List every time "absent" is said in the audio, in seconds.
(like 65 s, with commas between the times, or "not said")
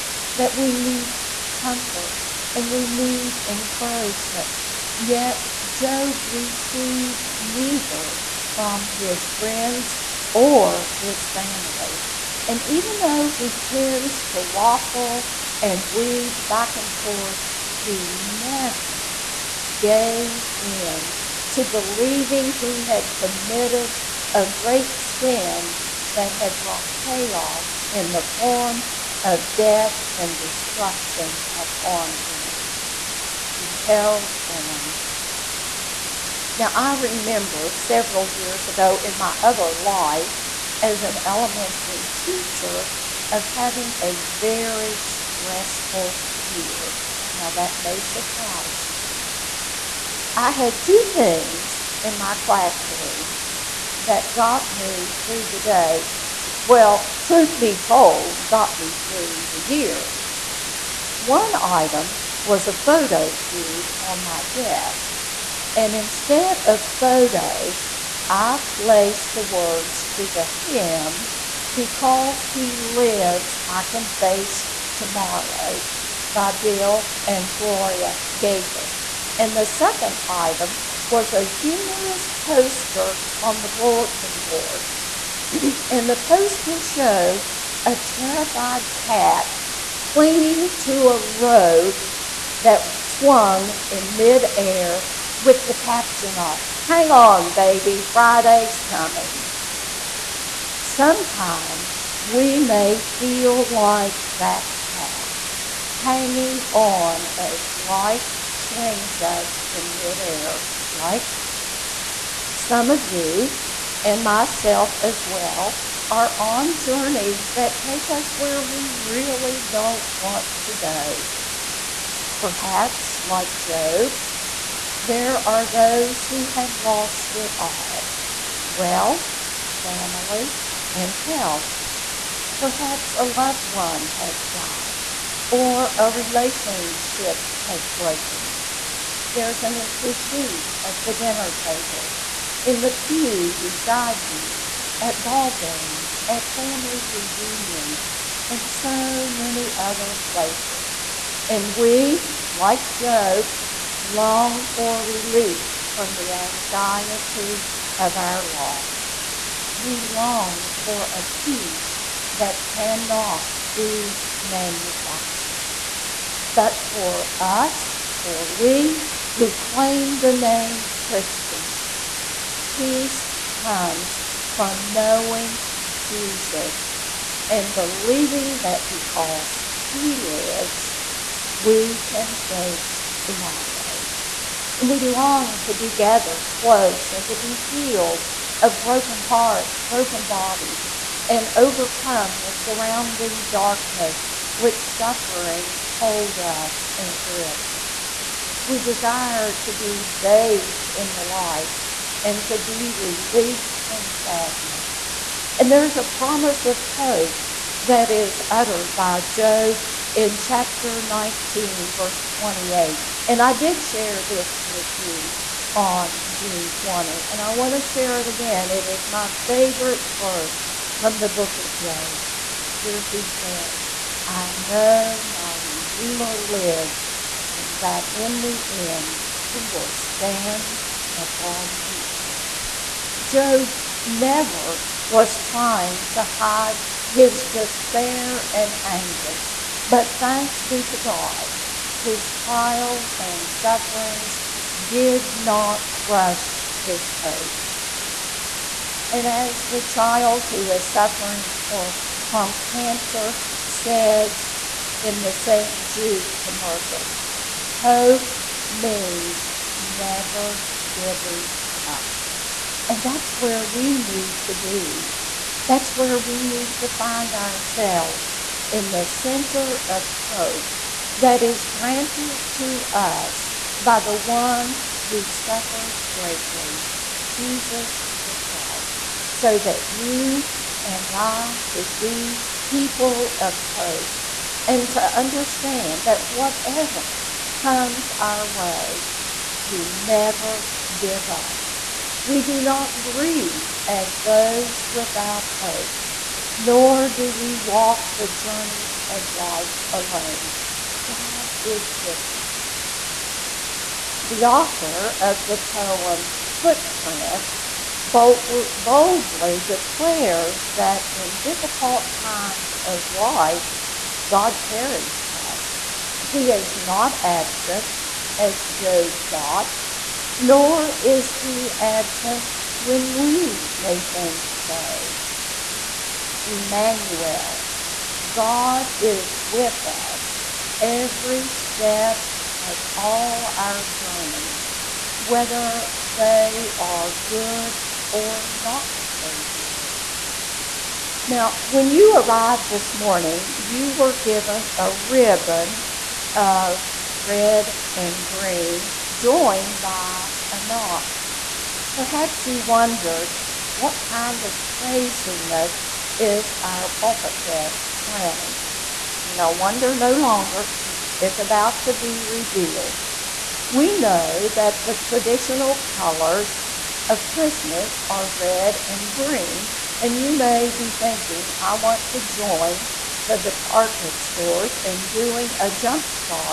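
317 s, 321 s.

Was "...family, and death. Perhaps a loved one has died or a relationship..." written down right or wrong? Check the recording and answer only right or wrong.
wrong.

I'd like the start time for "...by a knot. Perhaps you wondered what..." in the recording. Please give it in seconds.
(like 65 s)
349 s.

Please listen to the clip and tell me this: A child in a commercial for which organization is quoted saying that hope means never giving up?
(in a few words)
St. Jude.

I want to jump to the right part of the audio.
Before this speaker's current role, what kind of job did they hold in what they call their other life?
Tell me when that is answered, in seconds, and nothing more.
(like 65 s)
41 s.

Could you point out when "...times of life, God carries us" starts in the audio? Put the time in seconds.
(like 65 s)
312 s.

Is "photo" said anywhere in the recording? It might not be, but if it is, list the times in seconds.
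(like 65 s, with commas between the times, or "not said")
62 s, 66 s.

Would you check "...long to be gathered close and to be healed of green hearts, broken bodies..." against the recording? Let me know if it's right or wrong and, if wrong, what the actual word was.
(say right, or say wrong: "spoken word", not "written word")
wrong: "broken", not "green".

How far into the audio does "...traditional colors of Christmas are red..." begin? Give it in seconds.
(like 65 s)
364 s.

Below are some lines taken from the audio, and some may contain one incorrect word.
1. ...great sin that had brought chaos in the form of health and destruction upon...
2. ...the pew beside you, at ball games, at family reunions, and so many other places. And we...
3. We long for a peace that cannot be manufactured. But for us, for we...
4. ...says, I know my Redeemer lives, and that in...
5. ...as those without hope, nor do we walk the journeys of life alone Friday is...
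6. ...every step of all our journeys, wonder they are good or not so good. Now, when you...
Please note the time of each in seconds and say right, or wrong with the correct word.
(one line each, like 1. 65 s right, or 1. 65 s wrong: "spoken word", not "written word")
1. 24 s wrong: "death", not "health"
2. 142 s right
3. 159 s right
4. 223 s right
5. 293 s wrong: "God", not "Friday"
6. 330 s wrong: "whether", not "wonder".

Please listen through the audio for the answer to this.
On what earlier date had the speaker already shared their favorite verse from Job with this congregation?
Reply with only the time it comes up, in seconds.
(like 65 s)
216 s.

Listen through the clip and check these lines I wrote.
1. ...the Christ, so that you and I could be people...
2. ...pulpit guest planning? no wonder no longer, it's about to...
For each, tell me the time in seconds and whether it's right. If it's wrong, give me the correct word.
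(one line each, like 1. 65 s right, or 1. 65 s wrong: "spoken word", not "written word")
1. 278 s right
2. 356 s right.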